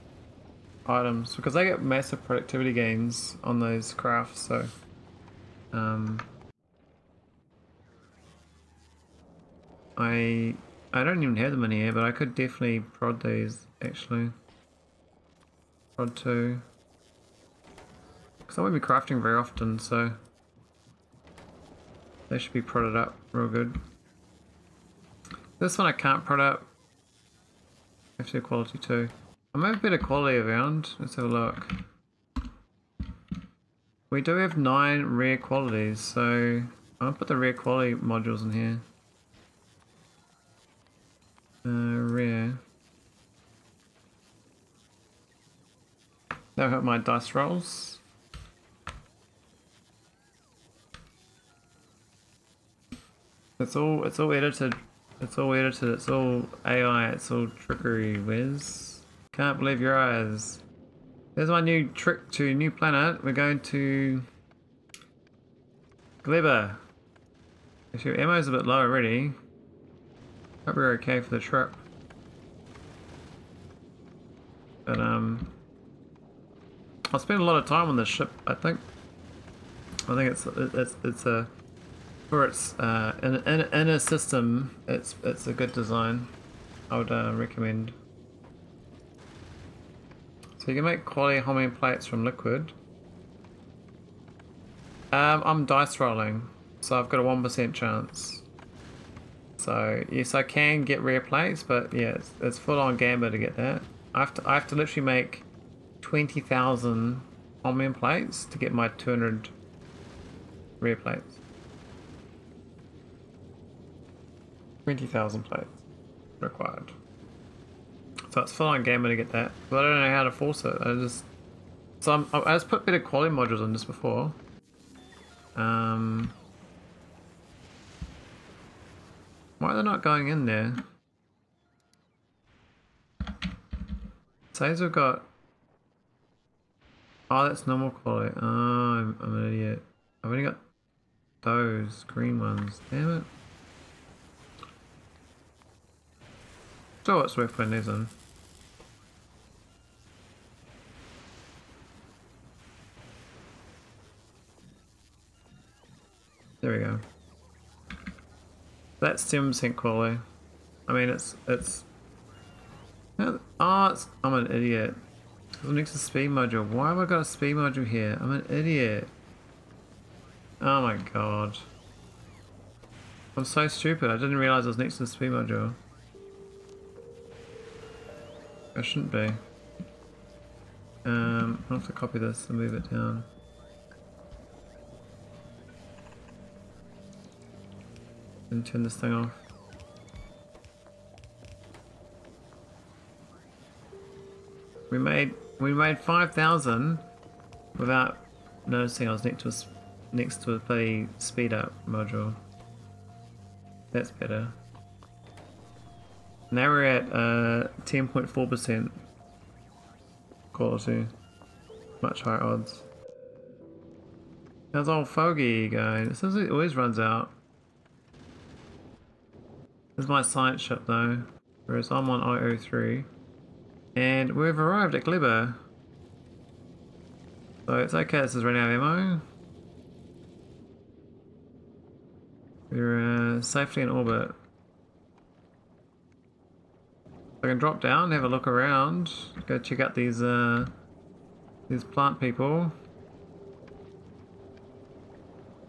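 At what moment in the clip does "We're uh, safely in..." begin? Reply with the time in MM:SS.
03:52.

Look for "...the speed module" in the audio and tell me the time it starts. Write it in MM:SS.
02:55.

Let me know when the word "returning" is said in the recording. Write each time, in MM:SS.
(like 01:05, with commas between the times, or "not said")
not said.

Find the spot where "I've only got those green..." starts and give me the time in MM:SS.
02:20.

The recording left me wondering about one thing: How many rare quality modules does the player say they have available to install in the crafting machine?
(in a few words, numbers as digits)
9.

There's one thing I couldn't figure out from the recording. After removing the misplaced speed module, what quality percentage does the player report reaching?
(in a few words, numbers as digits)
10.4%.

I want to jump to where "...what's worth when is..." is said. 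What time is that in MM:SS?
02:27.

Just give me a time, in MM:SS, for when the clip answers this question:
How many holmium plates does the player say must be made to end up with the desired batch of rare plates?
01:46.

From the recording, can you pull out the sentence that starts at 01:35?
Um, I'm dice rolling, so I've got a one percent chance.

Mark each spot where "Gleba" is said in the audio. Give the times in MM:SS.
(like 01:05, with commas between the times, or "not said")
01:06, 03:45.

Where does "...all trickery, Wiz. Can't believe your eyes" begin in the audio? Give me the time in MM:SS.
00:57.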